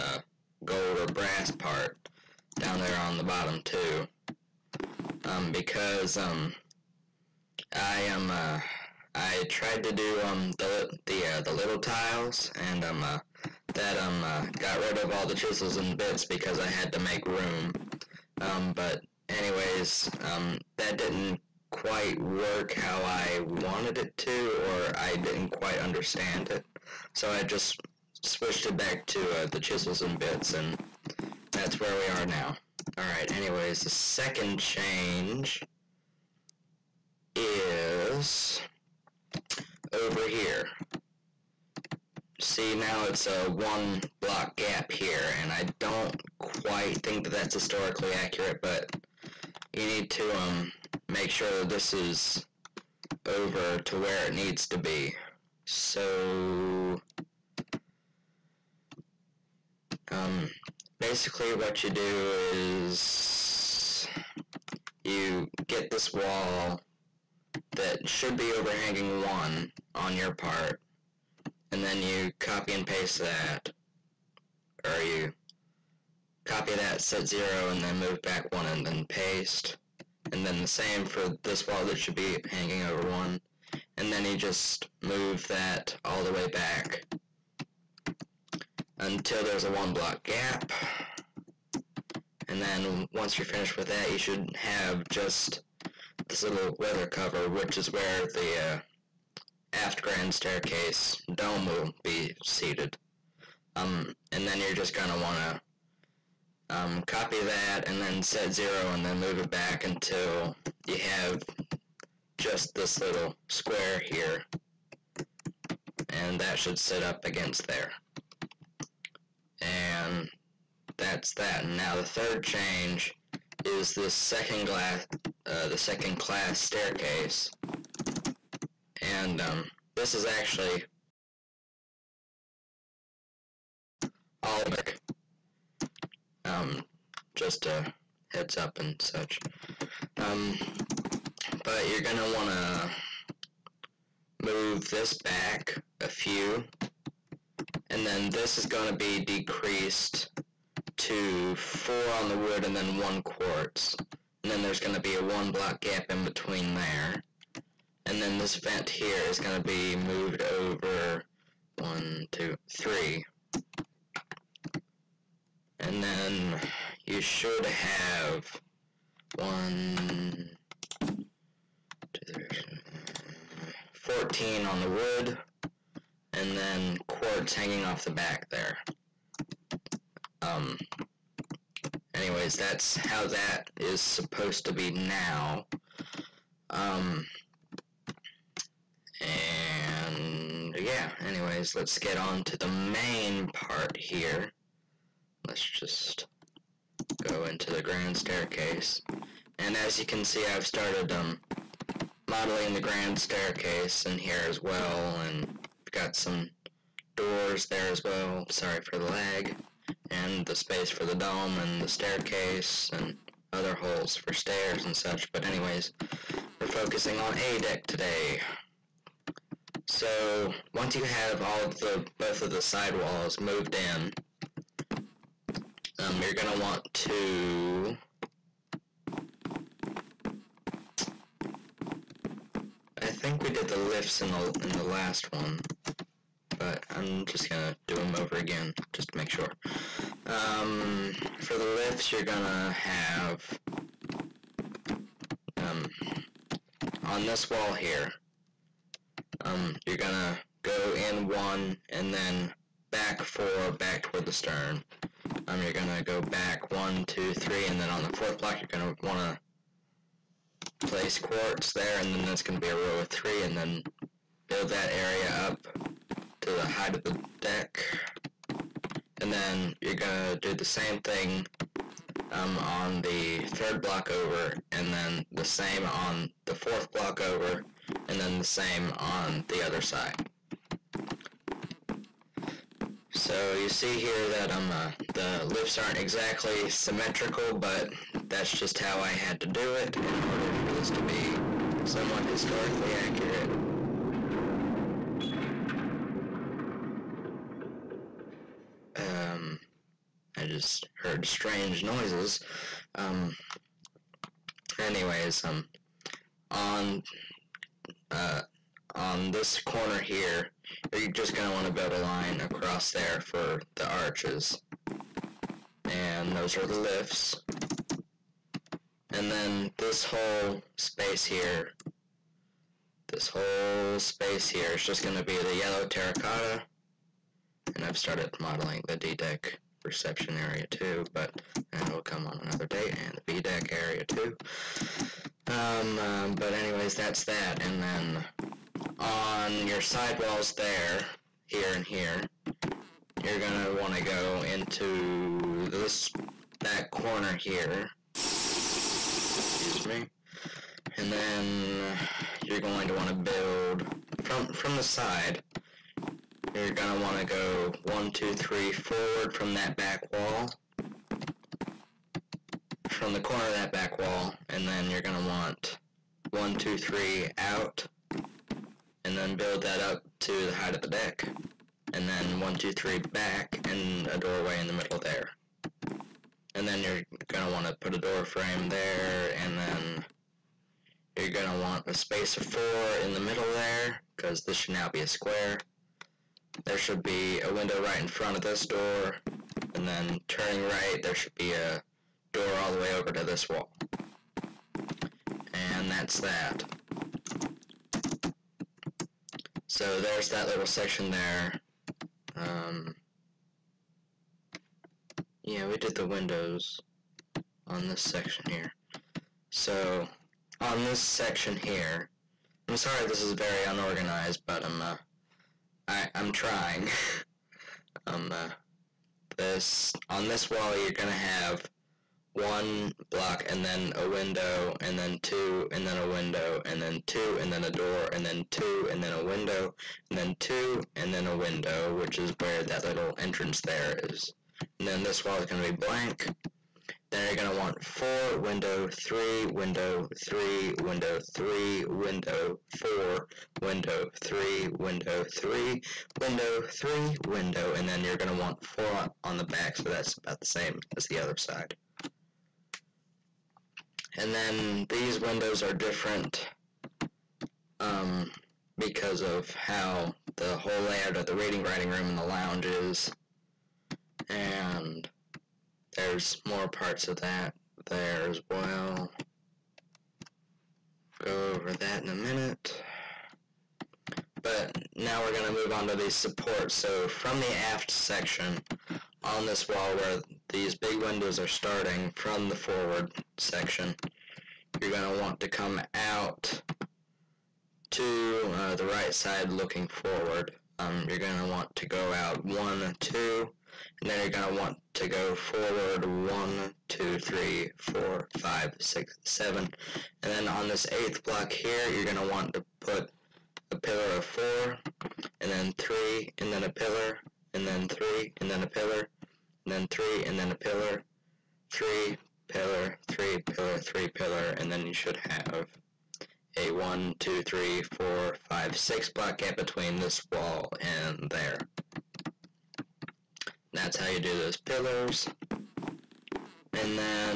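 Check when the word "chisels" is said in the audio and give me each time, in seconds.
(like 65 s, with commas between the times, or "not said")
15 s, 29 s.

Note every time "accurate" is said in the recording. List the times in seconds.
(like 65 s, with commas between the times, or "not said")
48 s, 292 s.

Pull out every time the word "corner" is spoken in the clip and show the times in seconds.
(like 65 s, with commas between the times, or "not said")
309 s, 346 s, 363 s.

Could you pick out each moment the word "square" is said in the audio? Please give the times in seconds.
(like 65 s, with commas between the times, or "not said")
113 s, 385 s.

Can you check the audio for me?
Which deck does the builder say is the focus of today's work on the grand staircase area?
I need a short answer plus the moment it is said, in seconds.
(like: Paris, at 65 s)
A deck, at 217 s.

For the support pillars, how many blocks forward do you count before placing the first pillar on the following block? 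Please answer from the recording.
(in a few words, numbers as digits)
7.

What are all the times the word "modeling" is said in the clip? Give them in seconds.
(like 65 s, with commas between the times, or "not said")
202 s, 328 s.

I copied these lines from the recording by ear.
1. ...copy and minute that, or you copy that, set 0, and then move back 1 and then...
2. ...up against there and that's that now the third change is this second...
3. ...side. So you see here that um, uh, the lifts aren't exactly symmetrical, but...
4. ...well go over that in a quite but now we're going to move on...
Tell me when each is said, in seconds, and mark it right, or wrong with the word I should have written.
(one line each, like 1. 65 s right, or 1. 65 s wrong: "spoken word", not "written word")
1. 72 s wrong: "paste", not "minute"
2. 117 s right
3. 279 s right
4. 468 s wrong: "minute", not "quite".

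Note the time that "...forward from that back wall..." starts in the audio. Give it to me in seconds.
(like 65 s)
358 s.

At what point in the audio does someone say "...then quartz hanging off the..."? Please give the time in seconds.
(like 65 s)
176 s.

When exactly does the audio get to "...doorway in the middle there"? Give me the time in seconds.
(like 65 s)
374 s.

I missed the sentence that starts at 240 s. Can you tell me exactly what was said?
Um, for the lifts, you're gonna have um, on this wall here.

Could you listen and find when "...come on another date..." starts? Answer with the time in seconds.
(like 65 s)
332 s.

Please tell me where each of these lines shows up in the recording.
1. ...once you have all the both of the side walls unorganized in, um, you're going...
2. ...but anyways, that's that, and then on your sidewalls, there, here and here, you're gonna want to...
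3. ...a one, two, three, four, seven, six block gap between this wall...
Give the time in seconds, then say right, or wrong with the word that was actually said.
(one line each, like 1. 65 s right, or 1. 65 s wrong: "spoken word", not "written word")
1. 220 s wrong: "moved", not "unorganized"
2. 336 s right
3. 516 s wrong: "five", not "seven".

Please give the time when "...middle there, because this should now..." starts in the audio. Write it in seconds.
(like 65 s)
383 s.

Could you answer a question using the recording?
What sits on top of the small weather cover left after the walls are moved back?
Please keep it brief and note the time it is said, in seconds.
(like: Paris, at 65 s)
Aft grand staircase dome, at 99 s.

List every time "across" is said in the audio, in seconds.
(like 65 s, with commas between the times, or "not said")
312 s.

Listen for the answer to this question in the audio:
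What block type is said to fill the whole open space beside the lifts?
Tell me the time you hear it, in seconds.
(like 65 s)
325 s.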